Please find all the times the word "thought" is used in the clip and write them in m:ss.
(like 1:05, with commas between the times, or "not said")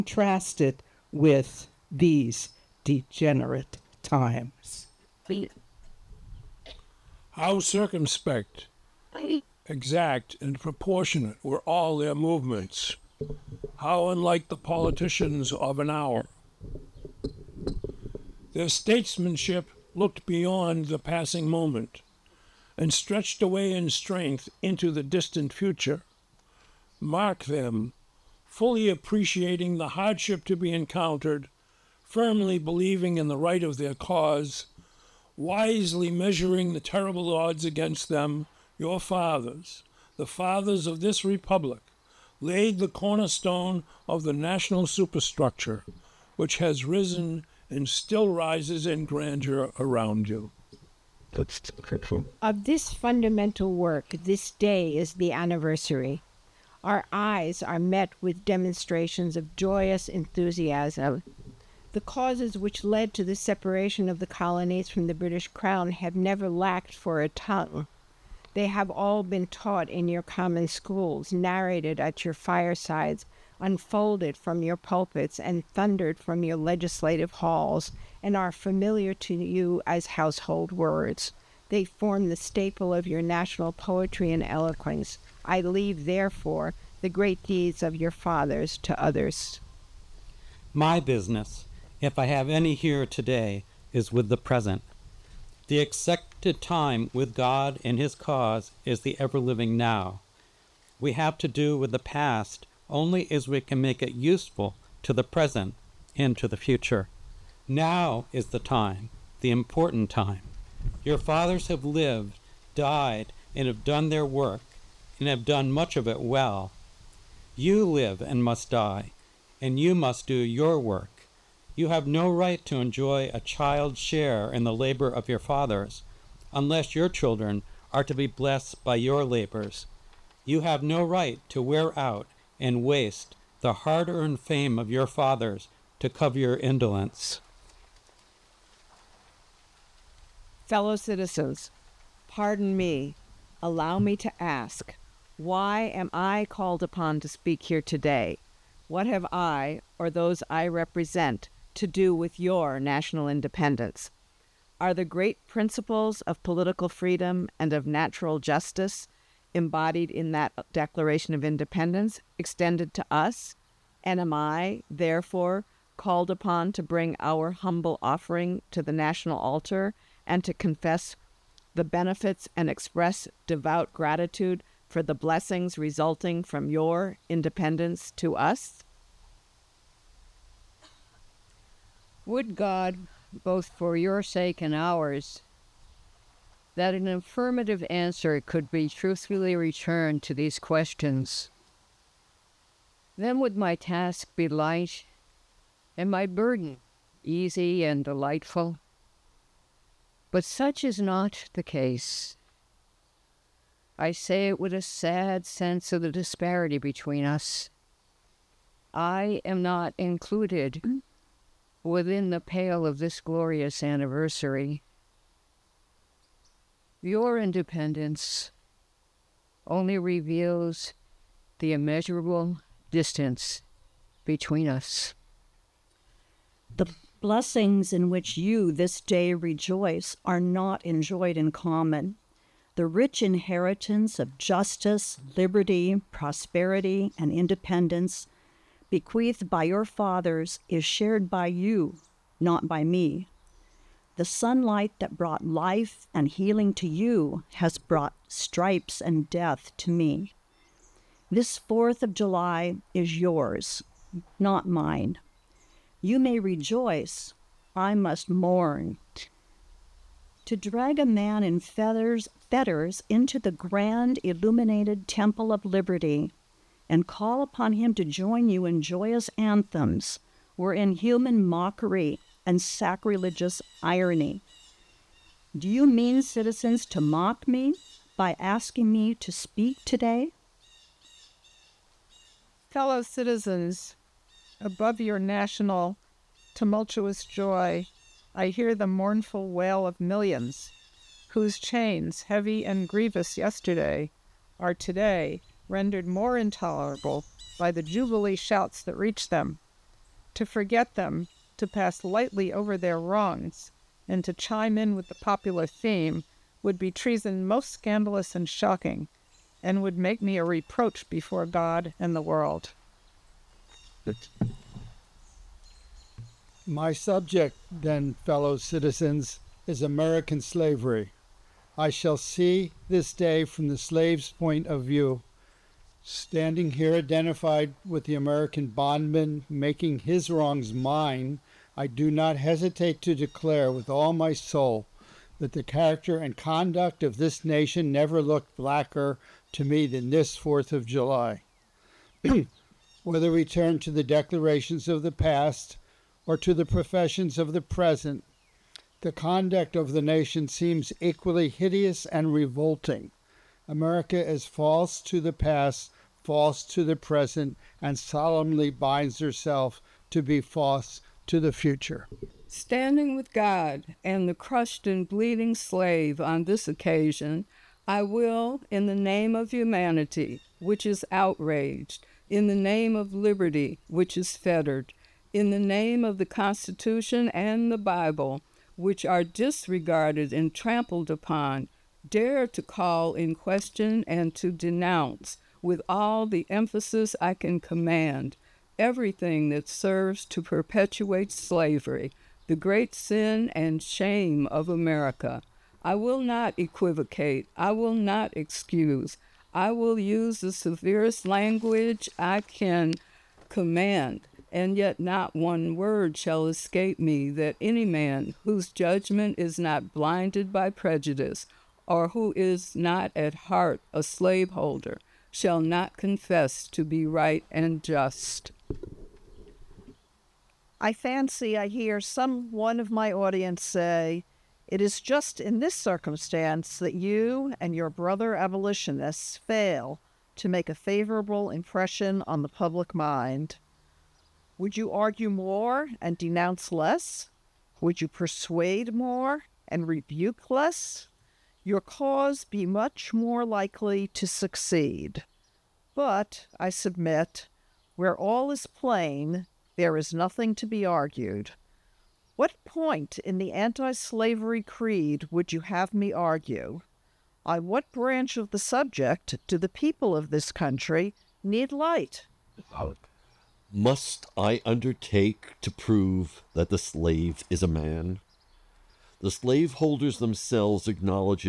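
not said.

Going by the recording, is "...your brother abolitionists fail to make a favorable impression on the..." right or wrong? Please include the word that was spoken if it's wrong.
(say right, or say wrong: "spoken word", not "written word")
right.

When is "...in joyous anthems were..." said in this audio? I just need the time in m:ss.
4:28.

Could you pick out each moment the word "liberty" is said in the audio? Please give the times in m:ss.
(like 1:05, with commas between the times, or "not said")
3:55, 4:25, 6:13.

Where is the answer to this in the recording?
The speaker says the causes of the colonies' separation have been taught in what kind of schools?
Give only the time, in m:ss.
1:10.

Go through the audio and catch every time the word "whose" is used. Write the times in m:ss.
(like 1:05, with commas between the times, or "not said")
4:51, 6:48.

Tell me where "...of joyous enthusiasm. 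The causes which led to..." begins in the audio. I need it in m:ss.
0:59.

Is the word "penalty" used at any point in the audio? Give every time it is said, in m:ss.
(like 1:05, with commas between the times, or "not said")
not said.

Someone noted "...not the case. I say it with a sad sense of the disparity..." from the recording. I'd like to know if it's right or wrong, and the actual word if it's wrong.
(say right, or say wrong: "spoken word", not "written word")
right.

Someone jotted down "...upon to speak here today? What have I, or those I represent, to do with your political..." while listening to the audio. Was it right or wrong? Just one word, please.
wrong.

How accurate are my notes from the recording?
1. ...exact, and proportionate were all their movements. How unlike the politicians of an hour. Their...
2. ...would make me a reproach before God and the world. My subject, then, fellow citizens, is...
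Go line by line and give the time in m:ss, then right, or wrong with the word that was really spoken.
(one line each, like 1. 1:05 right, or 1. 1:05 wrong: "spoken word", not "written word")
1. 0:09 right
2. 5:09 right.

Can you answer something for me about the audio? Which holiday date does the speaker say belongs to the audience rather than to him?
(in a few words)
4th of July.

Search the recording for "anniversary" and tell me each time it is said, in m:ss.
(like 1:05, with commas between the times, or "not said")
0:55, 3:33.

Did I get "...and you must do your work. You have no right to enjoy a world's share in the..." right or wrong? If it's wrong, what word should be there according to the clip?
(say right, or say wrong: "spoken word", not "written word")
wrong: "child", not "world".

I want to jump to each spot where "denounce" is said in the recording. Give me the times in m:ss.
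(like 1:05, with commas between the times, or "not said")
6:24, 7:16.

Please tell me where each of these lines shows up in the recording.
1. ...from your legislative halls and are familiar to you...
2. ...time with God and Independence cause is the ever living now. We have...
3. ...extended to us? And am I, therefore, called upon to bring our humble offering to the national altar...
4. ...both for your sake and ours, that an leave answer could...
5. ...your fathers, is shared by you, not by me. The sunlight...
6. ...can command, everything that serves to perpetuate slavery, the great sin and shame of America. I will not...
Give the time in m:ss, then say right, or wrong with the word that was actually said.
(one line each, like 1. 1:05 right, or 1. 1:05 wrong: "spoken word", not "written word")
1. 1:16 right
2. 1:36 wrong: "His", not "Independence"
3. 2:42 right
4. 3:03 wrong: "affirmative", not "leave"
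5. 3:59 right
6. 6:27 right.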